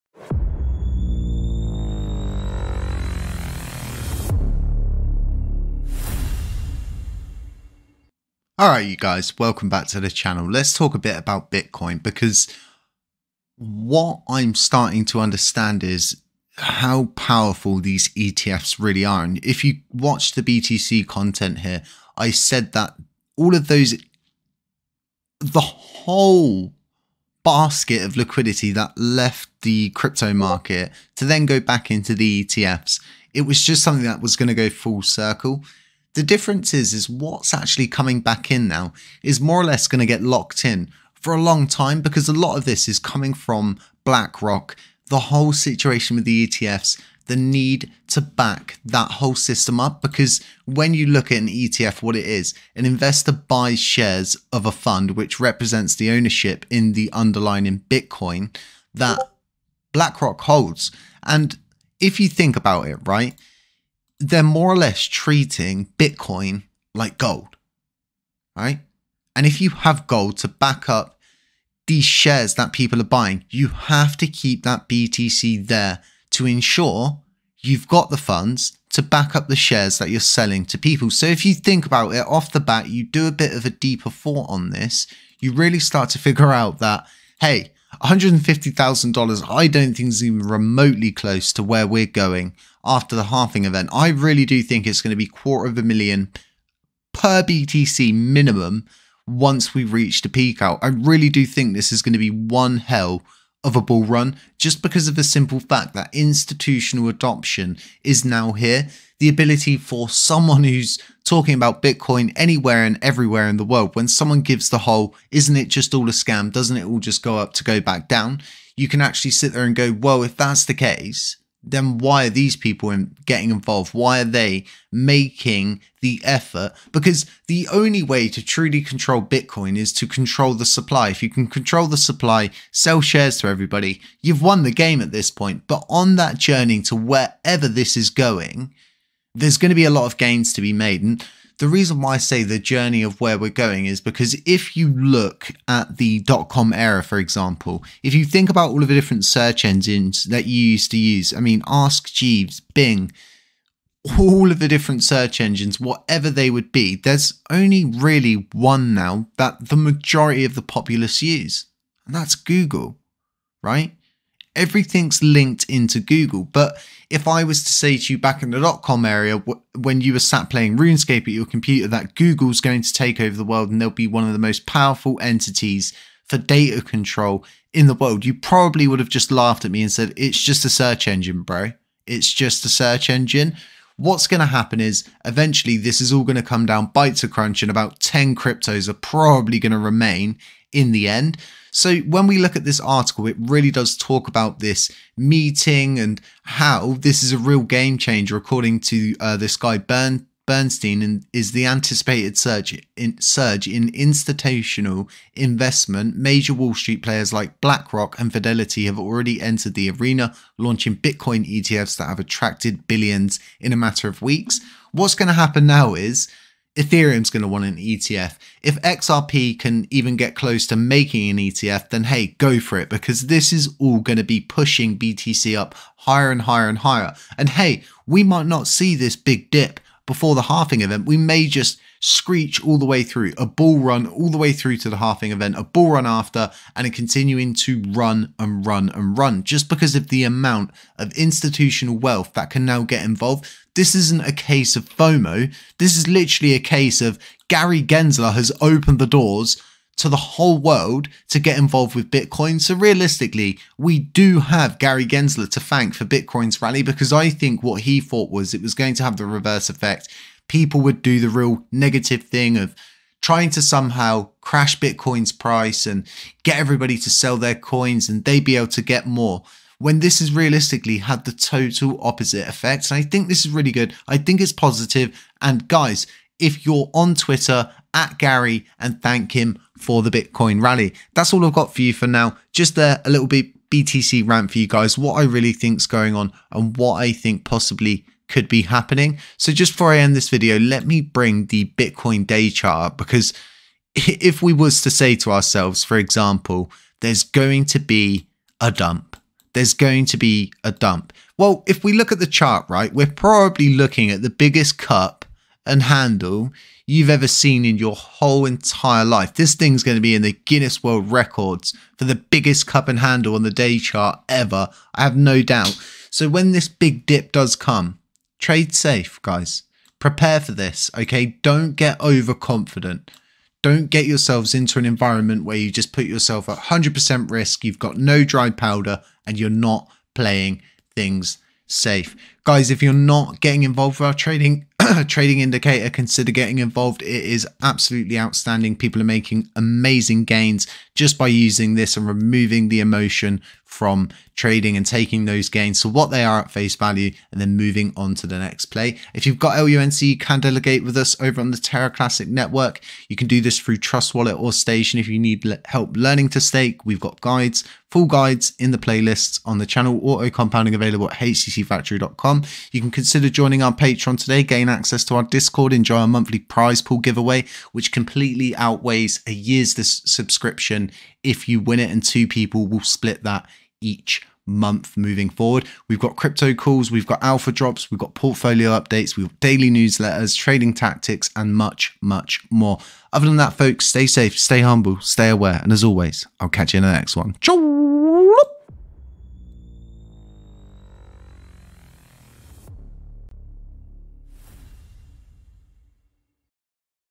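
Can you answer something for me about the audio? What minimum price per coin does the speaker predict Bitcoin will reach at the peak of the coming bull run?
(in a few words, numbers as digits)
quarter of a million.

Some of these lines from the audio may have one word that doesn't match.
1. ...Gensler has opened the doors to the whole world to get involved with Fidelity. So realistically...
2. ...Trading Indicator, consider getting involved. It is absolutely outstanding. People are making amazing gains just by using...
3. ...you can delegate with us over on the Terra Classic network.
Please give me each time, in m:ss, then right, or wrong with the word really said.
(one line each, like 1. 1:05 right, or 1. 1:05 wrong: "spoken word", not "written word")
1. 4:07 wrong: "Bitcoin", not "Fidelity"
2. 5:35 right
3. 5:50 right.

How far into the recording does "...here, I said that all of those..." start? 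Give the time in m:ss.
0:21.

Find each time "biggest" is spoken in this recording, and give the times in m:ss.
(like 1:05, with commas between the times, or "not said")
5:04, 5:12.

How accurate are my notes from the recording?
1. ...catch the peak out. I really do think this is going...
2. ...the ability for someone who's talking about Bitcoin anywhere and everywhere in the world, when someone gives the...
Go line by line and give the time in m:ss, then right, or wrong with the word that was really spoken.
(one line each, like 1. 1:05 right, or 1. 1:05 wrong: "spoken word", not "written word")
1. 1:39 wrong: "reach", not "catch"
2. 1:49 right.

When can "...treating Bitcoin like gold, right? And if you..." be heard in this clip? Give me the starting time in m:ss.
1:05.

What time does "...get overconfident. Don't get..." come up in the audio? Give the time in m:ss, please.
5:21.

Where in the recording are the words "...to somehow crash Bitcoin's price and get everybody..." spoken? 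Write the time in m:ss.
4:23.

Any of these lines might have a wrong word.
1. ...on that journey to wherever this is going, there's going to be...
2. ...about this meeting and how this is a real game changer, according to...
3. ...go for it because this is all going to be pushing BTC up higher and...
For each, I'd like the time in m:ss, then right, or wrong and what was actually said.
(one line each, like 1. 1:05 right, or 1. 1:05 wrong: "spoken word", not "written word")
1. 2:15 right
2. 3:14 right
3. 3:42 right.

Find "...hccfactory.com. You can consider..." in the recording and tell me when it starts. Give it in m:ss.
6:01.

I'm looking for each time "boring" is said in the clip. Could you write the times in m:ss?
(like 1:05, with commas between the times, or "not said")
not said.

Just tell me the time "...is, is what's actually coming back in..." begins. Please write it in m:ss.
0:36.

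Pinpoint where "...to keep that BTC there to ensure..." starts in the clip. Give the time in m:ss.
1:14.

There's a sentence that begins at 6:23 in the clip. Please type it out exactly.
Other than that, folks, stay safe, stay humble, stay aware, and as always, I'll catch you in the next one.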